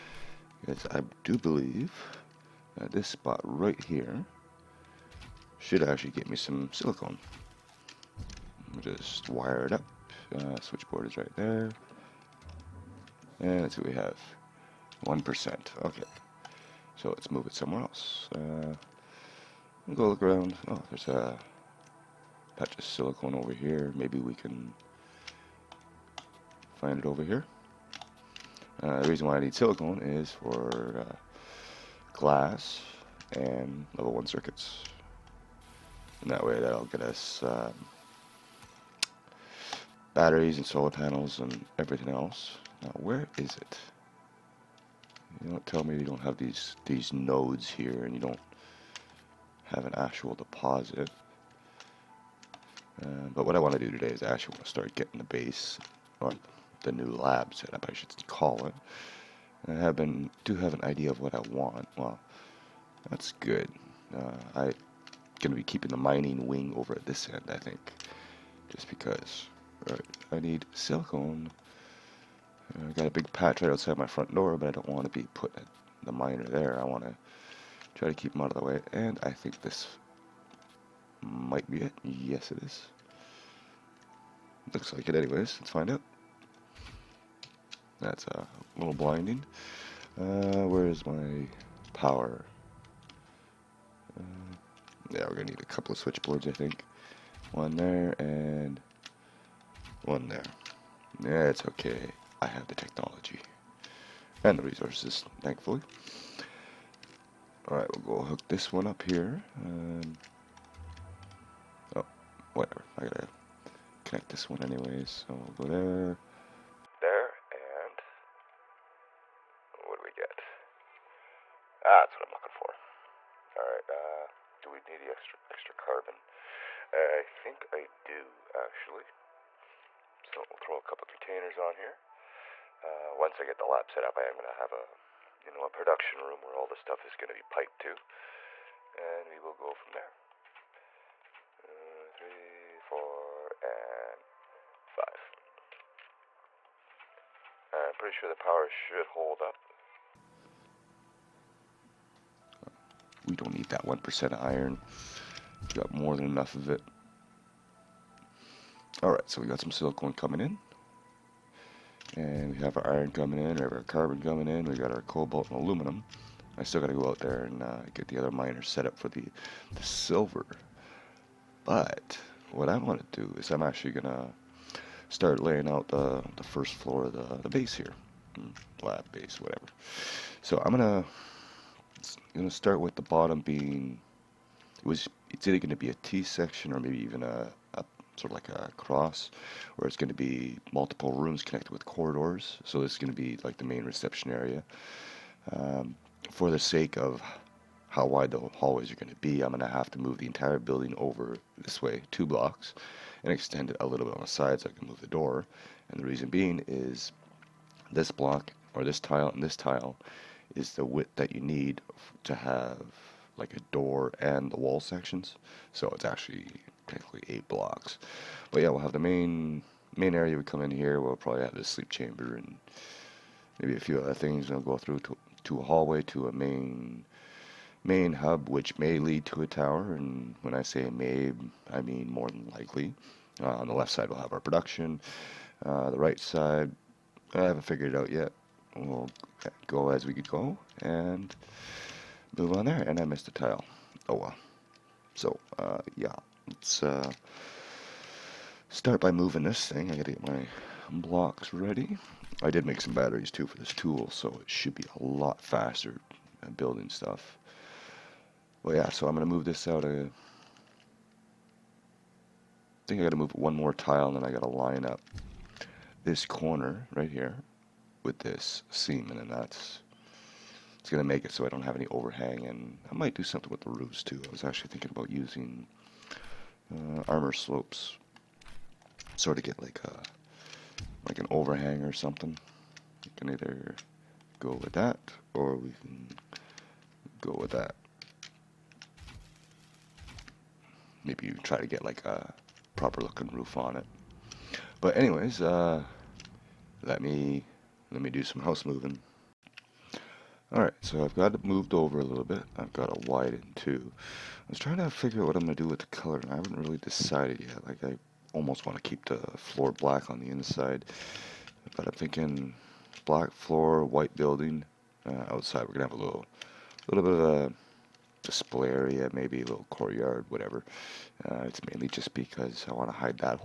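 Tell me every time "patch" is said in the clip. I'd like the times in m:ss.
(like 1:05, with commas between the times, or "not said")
0:22, 1:13.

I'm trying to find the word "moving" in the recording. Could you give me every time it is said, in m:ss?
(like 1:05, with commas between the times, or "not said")
4:09, 4:58.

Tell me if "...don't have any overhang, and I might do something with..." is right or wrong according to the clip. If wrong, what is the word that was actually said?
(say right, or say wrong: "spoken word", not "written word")
right.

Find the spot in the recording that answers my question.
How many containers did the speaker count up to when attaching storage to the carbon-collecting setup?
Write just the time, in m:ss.
2:24.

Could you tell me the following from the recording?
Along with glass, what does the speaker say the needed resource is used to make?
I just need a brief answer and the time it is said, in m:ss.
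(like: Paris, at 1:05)
level 1 circuits, at 0:33.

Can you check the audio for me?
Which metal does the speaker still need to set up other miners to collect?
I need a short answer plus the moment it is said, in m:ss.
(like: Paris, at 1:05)
silver, at 2:49.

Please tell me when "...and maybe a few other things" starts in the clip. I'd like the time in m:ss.
3:42.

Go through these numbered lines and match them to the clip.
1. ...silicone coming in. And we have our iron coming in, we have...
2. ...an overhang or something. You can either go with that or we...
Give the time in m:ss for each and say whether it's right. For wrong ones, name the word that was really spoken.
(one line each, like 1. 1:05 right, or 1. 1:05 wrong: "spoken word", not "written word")
1. 2:39 right
2. 4:41 right.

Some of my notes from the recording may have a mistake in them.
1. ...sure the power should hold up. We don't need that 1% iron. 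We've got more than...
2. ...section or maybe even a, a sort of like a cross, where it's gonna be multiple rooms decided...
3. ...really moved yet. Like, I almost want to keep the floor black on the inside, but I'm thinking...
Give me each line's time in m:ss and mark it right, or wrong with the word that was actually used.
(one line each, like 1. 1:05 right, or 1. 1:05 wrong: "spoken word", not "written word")
1. 2:28 right
2. 3:06 wrong: "connected", not "decided"
3. 5:06 wrong: "decided", not "moved".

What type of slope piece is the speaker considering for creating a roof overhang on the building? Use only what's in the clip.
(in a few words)
armor slopes.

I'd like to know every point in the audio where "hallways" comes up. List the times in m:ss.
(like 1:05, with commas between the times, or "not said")
3:18, 3:45.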